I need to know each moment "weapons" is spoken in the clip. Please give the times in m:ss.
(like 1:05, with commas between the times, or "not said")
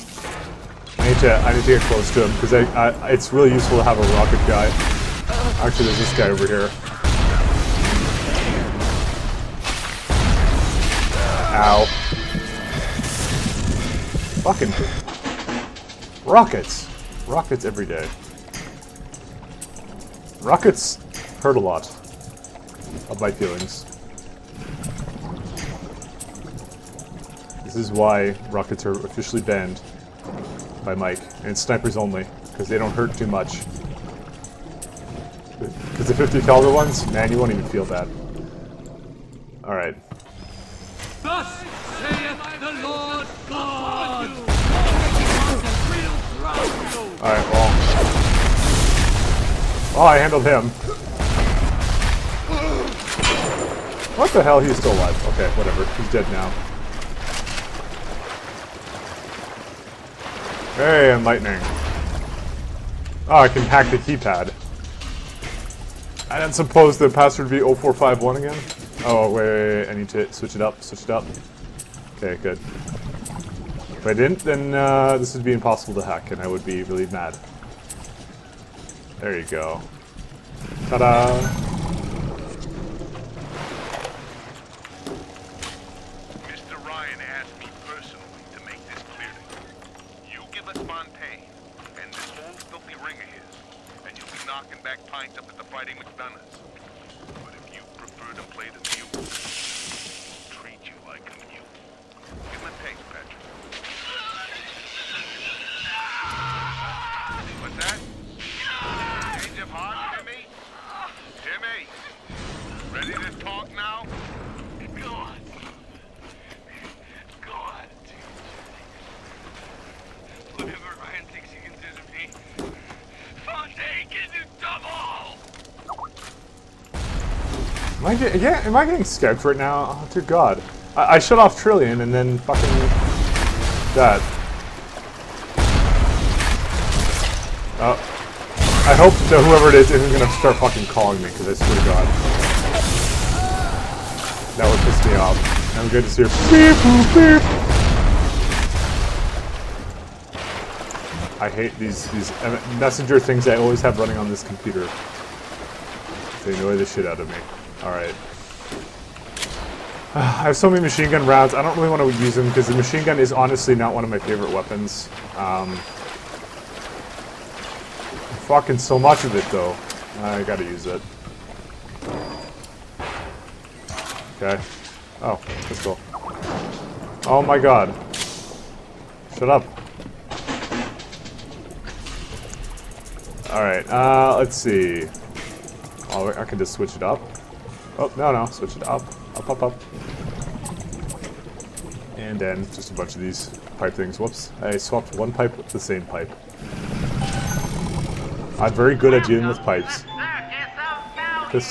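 2:44.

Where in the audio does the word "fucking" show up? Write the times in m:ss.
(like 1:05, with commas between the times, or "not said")
0:14, 2:12, 2:20, 2:48.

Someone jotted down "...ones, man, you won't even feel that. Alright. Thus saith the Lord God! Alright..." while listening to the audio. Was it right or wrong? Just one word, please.
right.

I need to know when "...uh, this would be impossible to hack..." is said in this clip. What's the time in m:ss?
1:14.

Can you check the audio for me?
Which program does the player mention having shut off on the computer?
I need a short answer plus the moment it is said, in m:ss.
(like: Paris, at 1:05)
Trillian, at 2:11.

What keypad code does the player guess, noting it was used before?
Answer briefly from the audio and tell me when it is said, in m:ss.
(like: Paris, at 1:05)
0451, at 1:07.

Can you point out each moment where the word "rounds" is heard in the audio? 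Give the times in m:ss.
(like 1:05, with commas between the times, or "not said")
2:41.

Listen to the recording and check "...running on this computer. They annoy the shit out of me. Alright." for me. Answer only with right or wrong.
right.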